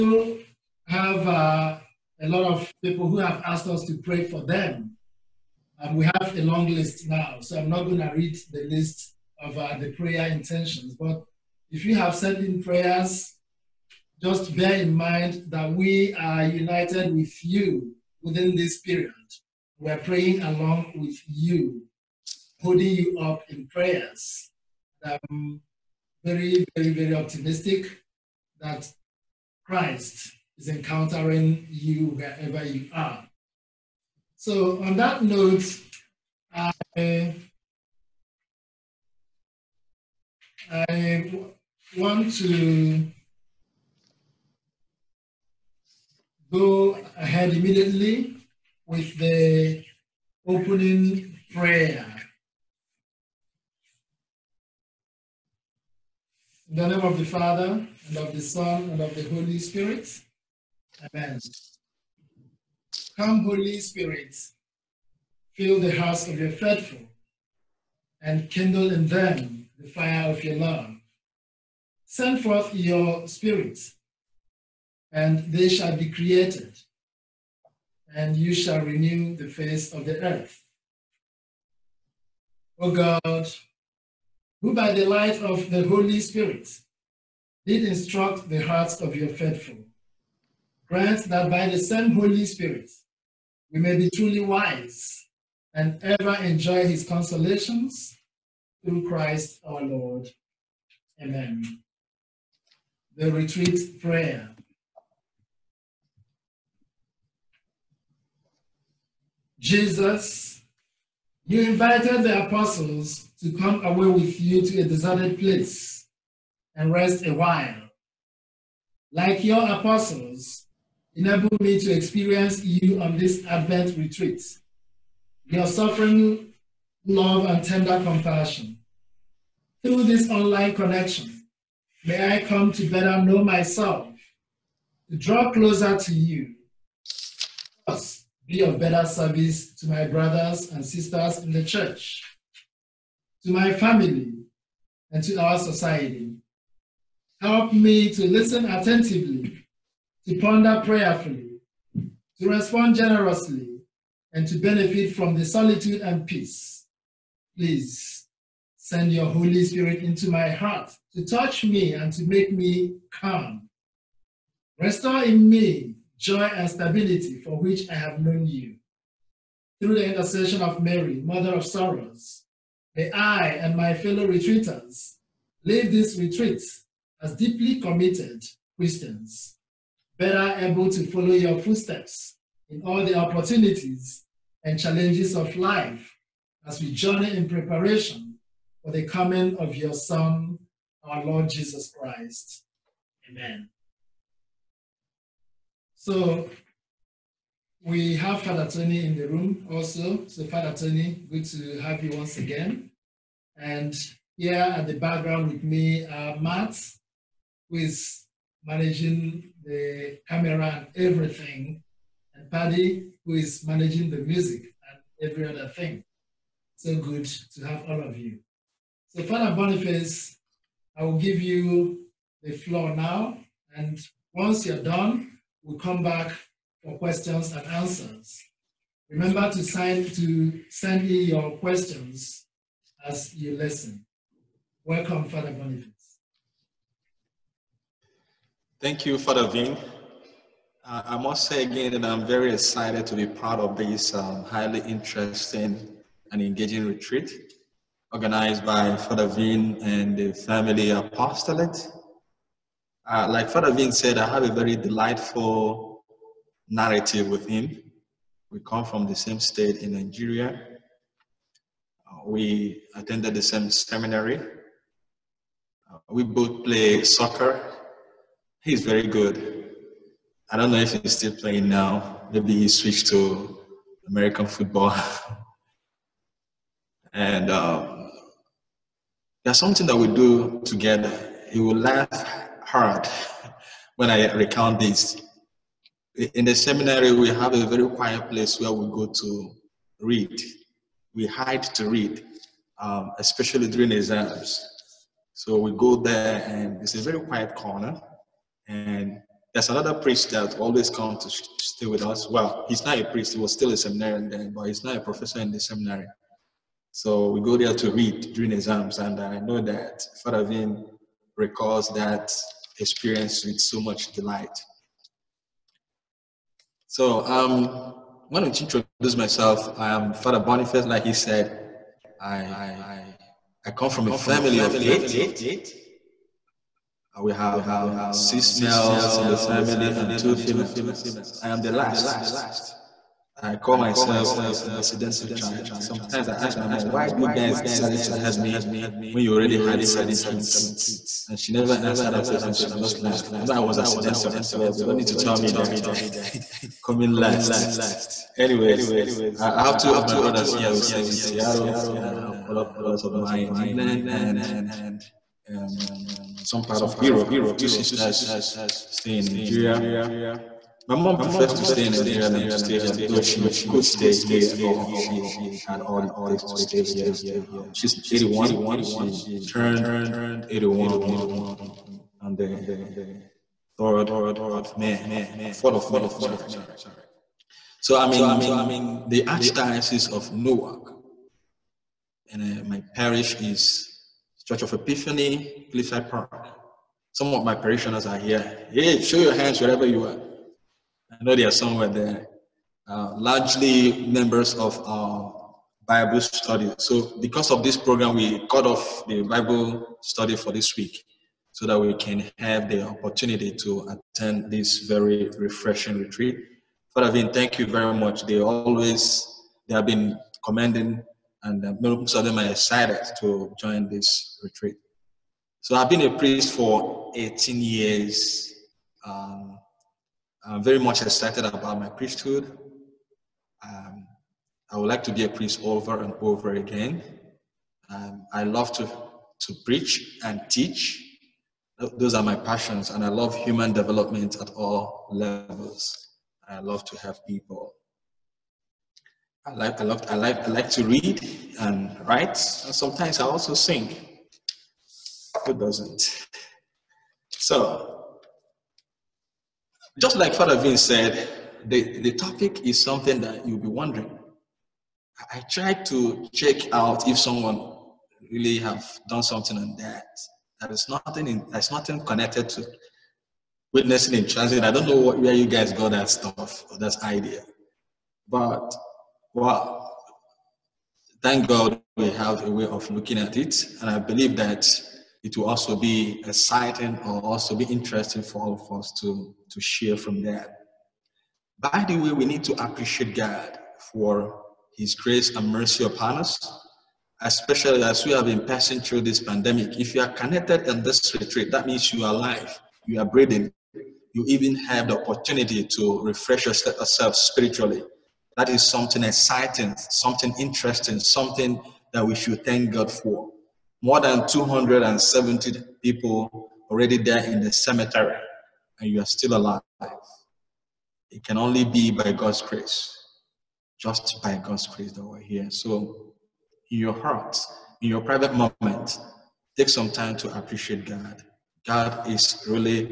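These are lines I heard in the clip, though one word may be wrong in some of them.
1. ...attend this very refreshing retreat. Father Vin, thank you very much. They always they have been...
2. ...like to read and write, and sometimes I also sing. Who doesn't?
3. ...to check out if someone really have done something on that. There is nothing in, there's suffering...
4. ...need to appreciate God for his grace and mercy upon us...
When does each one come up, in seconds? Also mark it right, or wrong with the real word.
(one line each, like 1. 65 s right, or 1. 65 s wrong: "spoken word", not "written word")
1. 403 s right
2. 440 s right
3. 455 s wrong: "nothing", not "suffering"
4. 482 s right.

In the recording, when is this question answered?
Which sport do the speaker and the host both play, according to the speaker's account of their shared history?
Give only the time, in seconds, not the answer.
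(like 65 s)
267 s.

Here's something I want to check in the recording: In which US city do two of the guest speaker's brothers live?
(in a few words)
Seattle.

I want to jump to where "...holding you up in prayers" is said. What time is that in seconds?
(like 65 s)
22 s.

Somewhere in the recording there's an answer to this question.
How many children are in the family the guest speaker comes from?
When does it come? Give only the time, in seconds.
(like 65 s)
324 s.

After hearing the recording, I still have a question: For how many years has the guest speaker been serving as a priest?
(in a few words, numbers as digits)
18.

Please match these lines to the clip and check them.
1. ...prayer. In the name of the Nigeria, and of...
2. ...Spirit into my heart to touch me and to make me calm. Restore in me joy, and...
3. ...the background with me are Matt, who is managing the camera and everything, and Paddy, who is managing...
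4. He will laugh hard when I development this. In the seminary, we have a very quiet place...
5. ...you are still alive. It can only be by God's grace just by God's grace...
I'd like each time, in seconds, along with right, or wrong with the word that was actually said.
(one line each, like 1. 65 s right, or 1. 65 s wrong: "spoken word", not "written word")
1. 51 s wrong: "Father", not "Nigeria"
2. 159 s right
3. 204 s right
4. 281 s wrong: "recount", not "development"
5. 508 s right.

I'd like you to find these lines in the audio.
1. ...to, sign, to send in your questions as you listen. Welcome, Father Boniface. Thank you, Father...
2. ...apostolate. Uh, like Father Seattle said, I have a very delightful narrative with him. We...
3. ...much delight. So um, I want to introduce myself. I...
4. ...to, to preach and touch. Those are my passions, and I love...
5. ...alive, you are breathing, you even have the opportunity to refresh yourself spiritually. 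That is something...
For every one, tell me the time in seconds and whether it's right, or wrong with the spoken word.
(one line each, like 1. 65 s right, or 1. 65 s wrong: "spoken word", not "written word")
1. 229 s right
2. 250 s wrong: "Vin", not "Seattle"
3. 313 s right
4. 428 s wrong: "teach", not "touch"
5. 492 s right.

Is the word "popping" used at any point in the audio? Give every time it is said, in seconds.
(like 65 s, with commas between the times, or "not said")
not said.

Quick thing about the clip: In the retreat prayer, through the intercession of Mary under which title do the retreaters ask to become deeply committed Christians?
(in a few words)
Mother of Sorrows.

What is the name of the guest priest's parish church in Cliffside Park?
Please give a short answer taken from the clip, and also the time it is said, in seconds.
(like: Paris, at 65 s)
Church of Epiphany, at 384 s.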